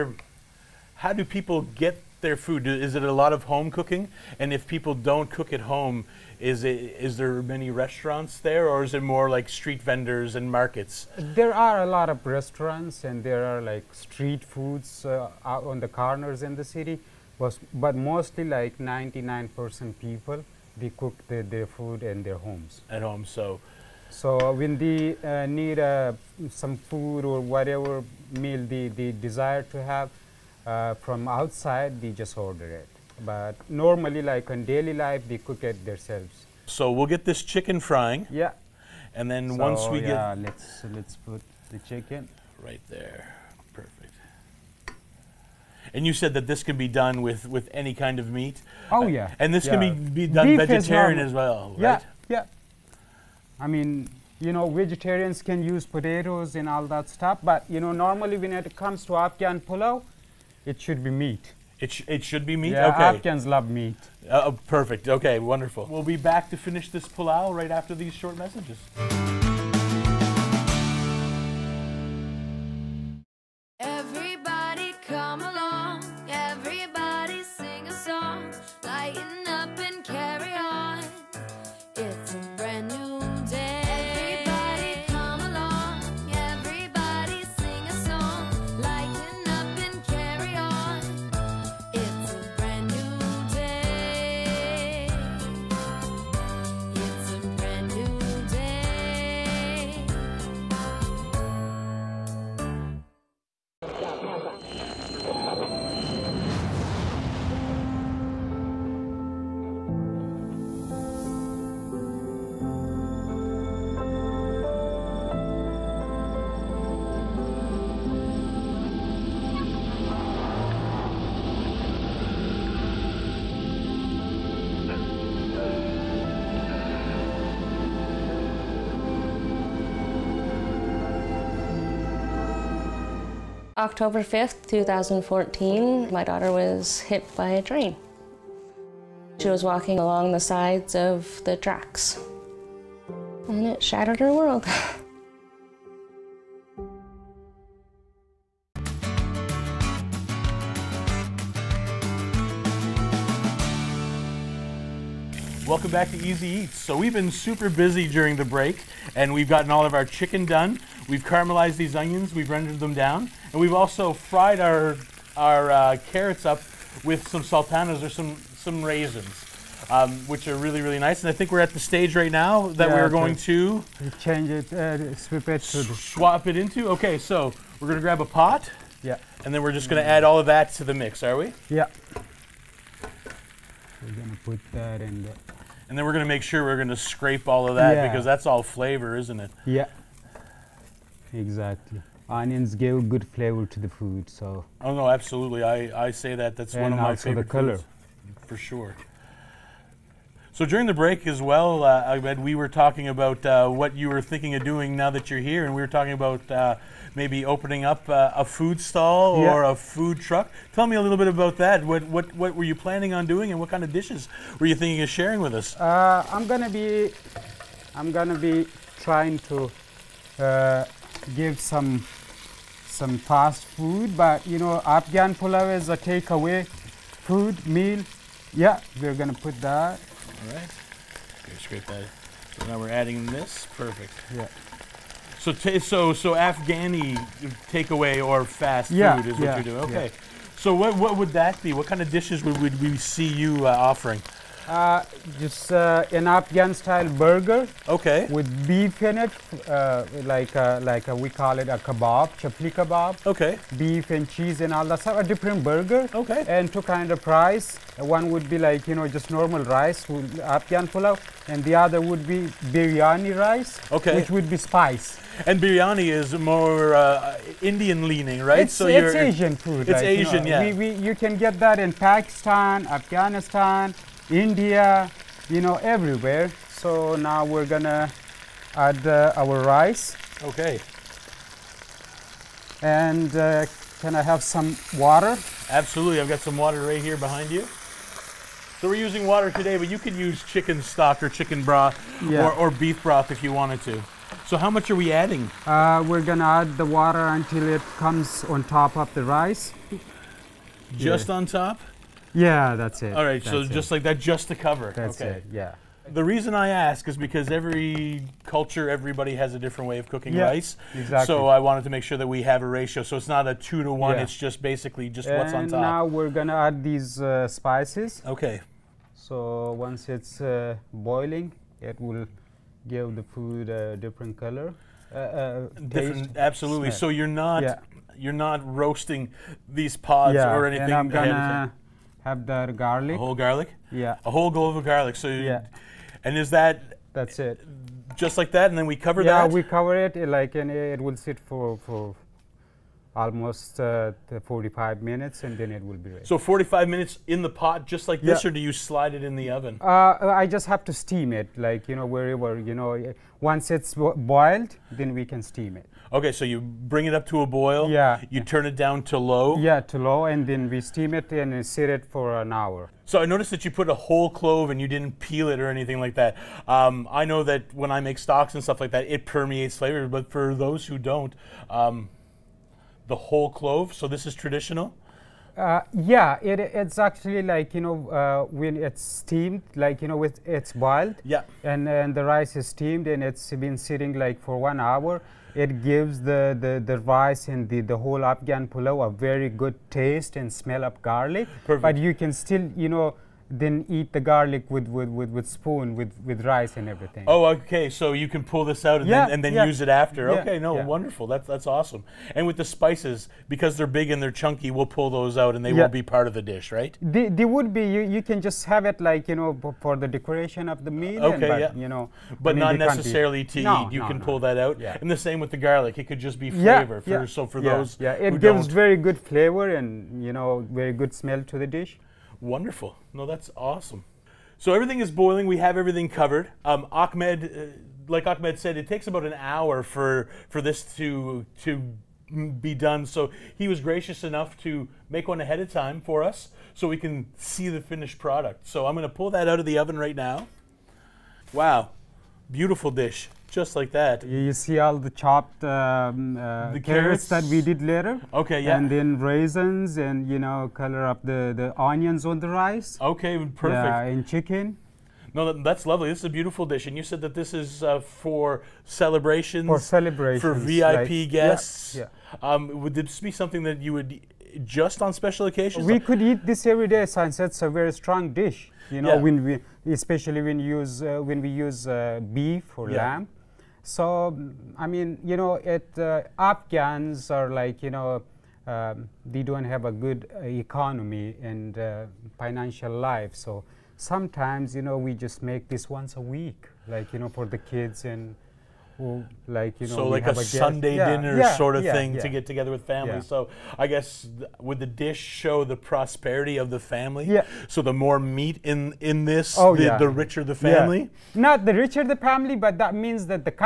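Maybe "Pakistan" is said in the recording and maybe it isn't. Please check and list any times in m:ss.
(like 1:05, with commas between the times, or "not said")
4:31.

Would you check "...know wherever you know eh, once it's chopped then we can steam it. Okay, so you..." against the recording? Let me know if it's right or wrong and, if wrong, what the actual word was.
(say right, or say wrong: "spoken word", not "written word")
wrong: "boiled", not "chopped".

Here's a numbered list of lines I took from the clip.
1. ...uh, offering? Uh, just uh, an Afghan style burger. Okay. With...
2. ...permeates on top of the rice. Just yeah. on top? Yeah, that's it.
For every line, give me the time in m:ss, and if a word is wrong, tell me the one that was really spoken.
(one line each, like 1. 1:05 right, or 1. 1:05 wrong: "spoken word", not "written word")
1. 4:03 right
2. 4:57 wrong: "comes", not "permeates".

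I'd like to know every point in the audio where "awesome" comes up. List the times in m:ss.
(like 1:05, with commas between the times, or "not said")
6:41, 7:03.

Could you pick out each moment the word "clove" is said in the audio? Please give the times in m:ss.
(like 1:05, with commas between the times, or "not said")
5:34, 6:04, 6:13.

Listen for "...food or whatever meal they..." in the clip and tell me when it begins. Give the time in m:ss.
0:26.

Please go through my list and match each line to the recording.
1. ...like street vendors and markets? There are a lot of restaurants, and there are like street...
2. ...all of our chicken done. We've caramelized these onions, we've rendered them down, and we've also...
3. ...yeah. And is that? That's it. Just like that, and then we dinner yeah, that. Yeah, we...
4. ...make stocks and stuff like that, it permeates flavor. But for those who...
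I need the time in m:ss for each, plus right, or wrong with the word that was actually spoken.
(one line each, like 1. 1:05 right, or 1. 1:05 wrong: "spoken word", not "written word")
1. 0:09 right
2. 2:39 right
3. 5:35 wrong: "cover", not "dinner"
4. 6:07 right.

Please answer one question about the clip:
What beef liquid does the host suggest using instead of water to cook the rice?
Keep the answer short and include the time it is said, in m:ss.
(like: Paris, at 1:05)
Beef broth, at 4:52.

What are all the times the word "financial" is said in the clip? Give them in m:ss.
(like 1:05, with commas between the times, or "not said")
8:02.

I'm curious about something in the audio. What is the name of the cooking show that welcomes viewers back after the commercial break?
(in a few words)
Easy Eats.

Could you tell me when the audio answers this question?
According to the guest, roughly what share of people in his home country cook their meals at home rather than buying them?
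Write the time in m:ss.
0:18.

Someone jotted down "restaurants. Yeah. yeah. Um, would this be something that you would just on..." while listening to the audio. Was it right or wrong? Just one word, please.
wrong.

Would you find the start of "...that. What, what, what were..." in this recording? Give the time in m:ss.
3:31.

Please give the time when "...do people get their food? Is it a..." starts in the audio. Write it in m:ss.
0:01.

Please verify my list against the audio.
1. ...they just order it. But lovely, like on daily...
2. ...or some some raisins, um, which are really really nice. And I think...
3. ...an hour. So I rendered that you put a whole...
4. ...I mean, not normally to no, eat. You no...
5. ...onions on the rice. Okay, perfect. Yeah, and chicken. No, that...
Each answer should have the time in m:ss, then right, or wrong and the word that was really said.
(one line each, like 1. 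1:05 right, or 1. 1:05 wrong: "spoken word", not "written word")
1. 0:31 wrong: "normally", not "lovely"
2. 2:48 right
3. 6:02 wrong: "noticed", not "rendered"
4. 6:52 wrong: "necessarily", not "normally"
5. 7:31 right.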